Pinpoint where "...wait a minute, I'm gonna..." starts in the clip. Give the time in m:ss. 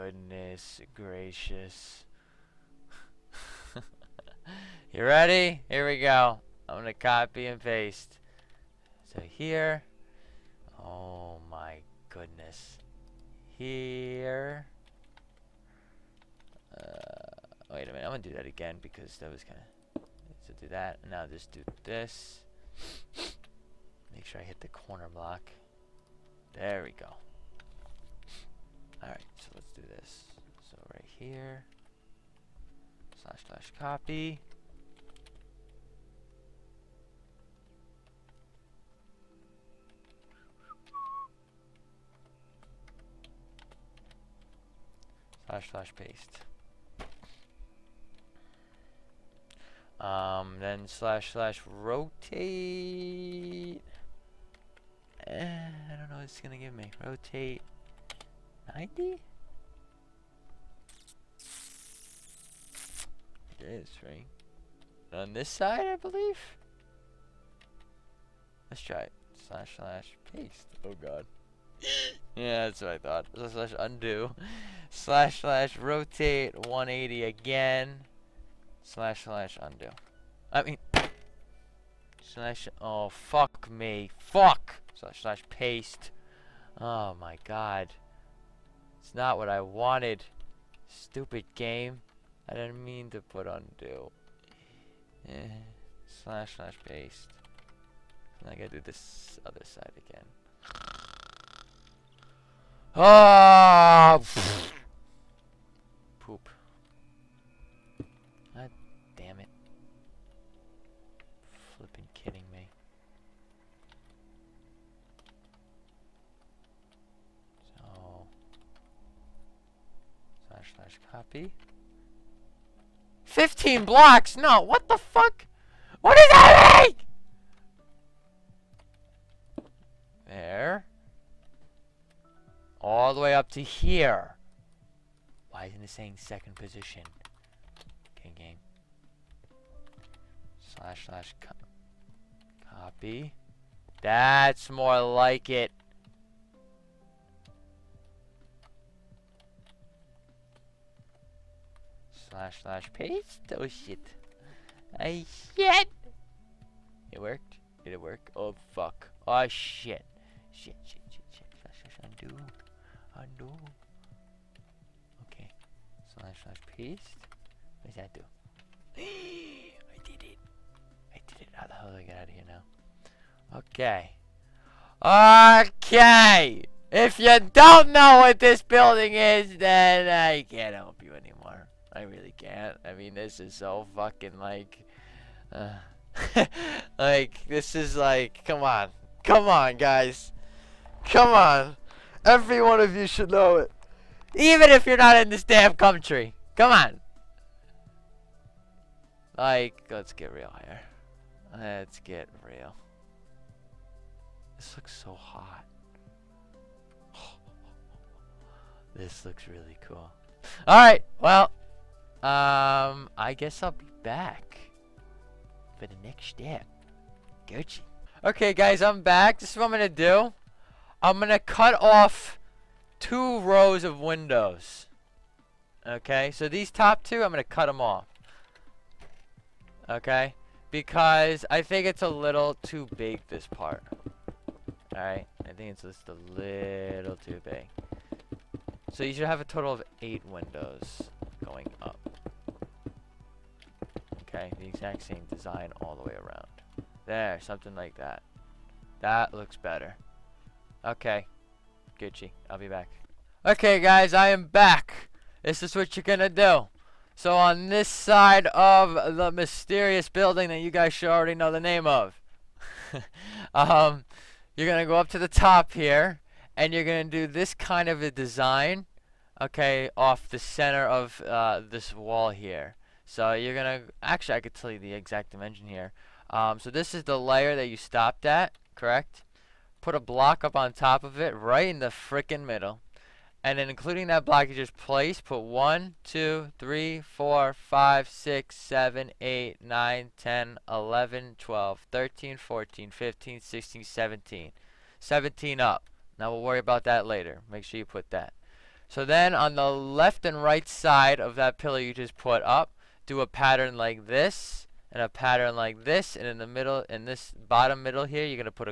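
0:17.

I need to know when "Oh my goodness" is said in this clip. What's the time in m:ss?
0:10.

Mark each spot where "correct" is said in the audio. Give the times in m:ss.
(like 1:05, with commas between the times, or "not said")
4:38.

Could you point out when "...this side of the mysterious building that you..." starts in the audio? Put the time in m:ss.
4:17.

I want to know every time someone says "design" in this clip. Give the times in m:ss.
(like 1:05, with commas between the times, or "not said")
4:05, 4:28.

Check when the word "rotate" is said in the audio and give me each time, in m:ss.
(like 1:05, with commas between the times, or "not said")
0:51, 0:57, 1:15.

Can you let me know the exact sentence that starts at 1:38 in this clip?
I gotta do this other side again.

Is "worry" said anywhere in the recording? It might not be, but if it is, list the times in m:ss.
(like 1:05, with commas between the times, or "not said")
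4:56.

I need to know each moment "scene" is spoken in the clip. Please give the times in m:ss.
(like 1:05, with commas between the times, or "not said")
not said.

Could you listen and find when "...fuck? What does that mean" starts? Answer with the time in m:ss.
2:04.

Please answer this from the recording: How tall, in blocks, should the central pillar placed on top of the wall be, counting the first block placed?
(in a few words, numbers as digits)
17.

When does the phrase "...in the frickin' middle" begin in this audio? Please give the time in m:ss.
4:41.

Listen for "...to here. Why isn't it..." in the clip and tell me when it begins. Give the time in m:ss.
2:13.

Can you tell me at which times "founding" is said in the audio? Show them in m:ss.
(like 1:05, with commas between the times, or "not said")
not said.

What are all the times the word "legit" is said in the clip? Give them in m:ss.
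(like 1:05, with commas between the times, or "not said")
not said.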